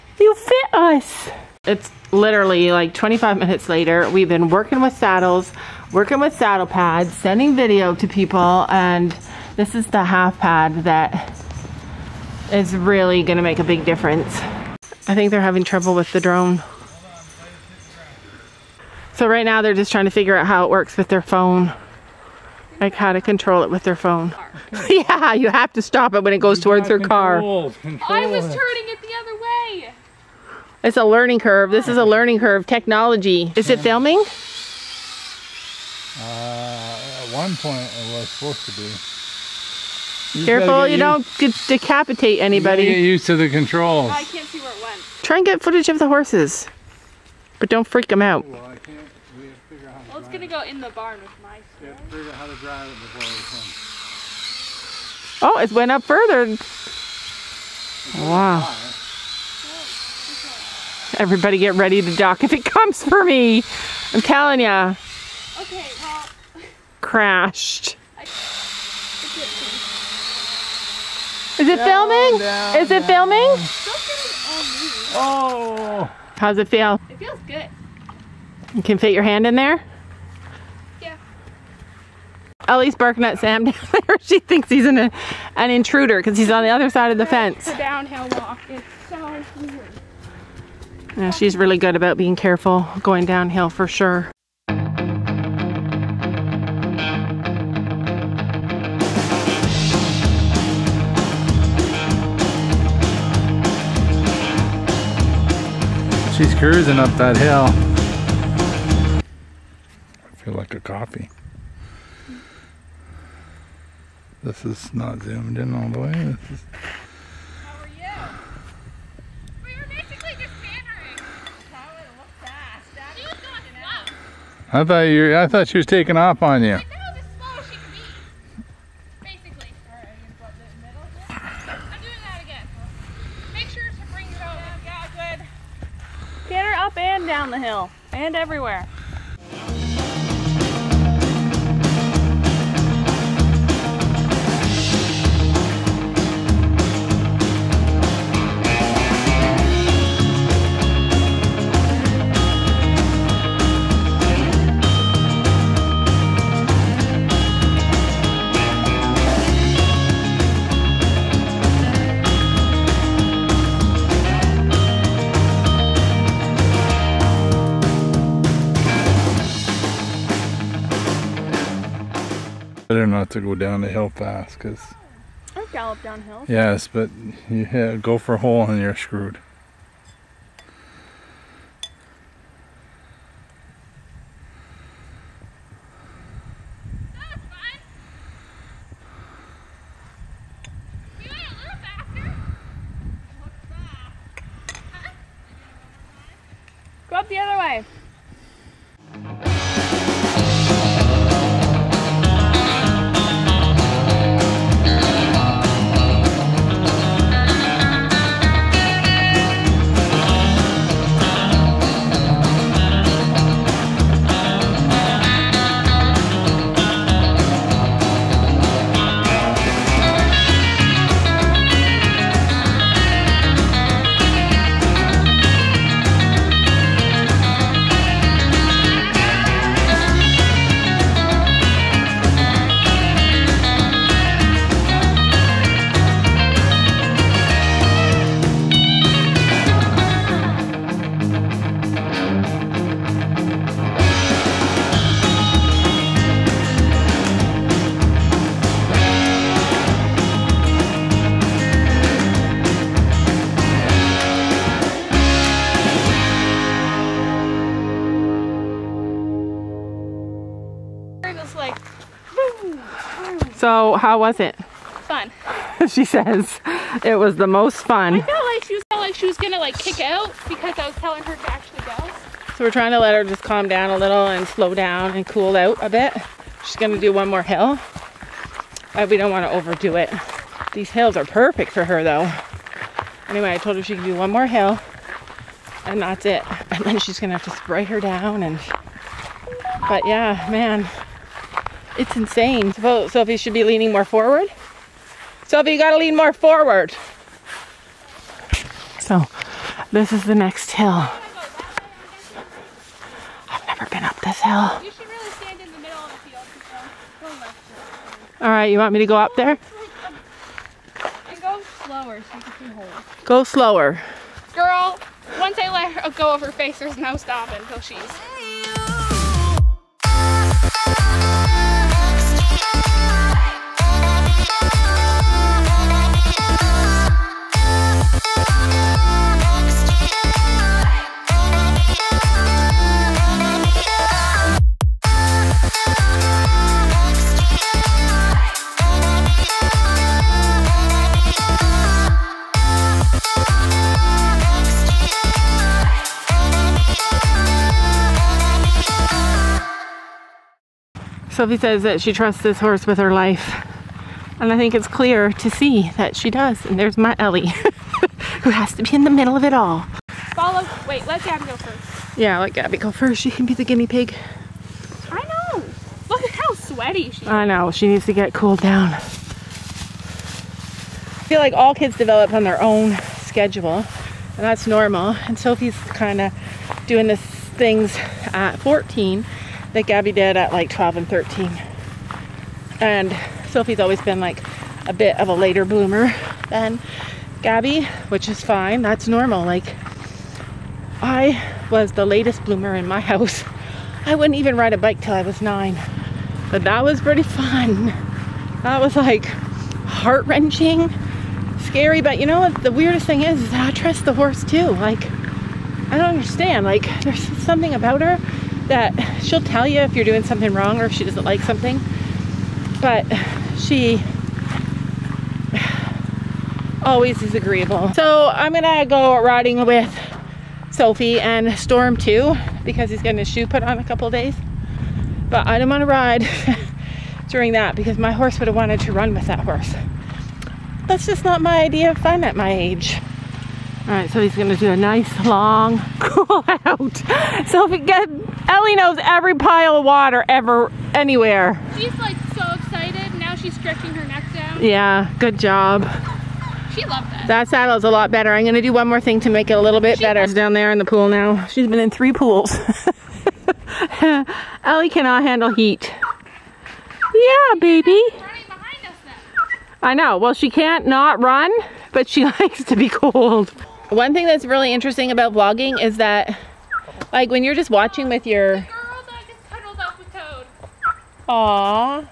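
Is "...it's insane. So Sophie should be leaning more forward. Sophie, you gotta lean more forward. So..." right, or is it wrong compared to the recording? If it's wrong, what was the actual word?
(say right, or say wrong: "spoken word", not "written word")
right.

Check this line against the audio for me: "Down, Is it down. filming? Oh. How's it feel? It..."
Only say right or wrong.
right.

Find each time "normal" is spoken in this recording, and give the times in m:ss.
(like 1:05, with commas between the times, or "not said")
6:14, 6:29.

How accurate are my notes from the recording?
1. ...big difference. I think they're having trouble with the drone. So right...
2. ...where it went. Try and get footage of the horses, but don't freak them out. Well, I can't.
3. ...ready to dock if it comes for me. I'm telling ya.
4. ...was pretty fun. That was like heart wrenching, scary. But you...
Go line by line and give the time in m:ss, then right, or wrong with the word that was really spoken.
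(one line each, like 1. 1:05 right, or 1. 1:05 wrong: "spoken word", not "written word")
1. 0:13 right
2. 0:44 right
3. 1:01 right
4. 6:36 right.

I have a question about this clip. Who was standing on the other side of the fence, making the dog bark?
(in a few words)
Sam.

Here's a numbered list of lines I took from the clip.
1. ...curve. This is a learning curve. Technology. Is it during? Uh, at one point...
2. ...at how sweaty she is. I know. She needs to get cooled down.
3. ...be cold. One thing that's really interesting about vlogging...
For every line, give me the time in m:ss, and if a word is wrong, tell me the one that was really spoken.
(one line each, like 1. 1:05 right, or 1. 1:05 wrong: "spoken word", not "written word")
1. 0:31 wrong: "filming", not "during"
2. 6:06 right
3. 7:42 right.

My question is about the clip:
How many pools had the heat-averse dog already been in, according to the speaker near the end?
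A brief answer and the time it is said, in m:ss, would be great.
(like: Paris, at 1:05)
3, at 7:31.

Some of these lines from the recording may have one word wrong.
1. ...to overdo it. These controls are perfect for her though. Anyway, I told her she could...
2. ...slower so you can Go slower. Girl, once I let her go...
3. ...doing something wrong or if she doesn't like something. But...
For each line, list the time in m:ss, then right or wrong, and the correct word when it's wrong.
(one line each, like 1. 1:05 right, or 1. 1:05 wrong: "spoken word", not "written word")
1. 4:39 wrong: "hills", not "controls"
2. 5:11 right
3. 6:50 right.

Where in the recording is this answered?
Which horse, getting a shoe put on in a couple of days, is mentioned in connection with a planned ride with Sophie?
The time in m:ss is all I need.
7:01.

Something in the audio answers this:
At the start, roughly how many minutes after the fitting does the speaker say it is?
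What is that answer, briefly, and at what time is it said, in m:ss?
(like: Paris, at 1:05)
25, at 0:02.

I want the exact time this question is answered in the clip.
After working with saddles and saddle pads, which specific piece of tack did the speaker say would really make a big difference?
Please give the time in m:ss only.
0:10.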